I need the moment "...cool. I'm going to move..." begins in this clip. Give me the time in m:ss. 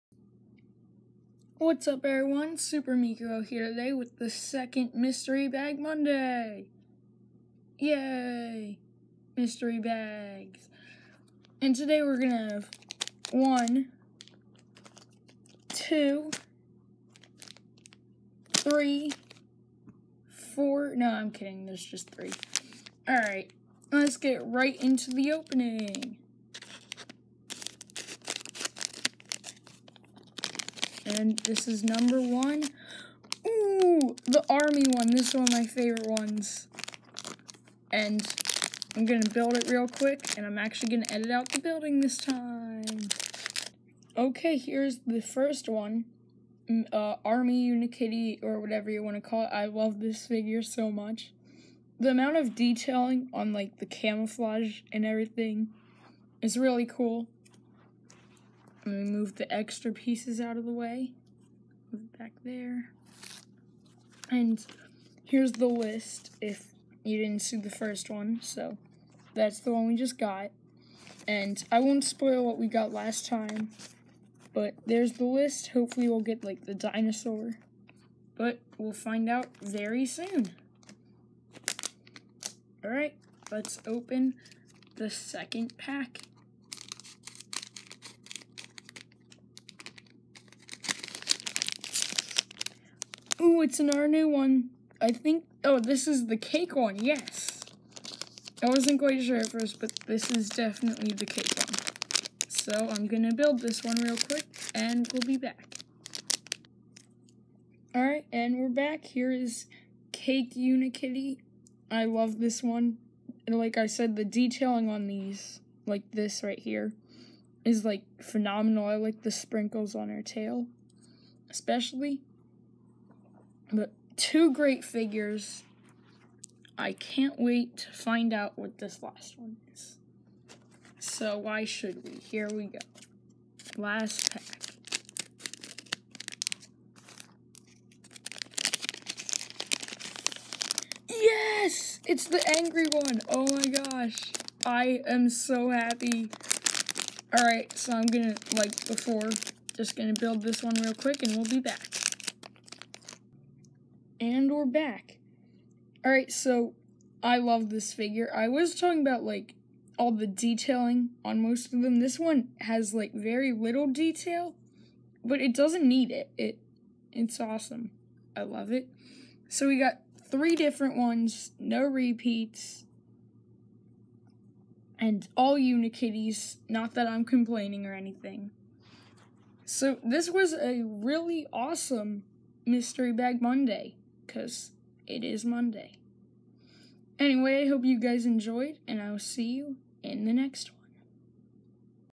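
0:56.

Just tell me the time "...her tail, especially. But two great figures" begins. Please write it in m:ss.
2:00.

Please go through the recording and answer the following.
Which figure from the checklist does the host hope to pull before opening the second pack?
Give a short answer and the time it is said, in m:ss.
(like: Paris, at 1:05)
The dinosaur, at 1:16.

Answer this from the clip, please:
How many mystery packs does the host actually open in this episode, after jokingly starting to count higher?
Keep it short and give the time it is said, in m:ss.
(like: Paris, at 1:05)
3, at 0:21.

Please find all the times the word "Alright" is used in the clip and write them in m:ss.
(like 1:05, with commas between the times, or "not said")
1:22, 1:47, 2:27, 2:36.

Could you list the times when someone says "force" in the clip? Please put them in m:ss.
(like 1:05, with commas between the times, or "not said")
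not said.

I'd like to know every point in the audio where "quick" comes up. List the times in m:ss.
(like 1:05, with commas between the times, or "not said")
0:39, 1:44, 2:30.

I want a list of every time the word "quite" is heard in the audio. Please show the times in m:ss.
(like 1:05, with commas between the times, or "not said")
1:38.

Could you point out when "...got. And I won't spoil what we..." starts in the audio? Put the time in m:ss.
1:10.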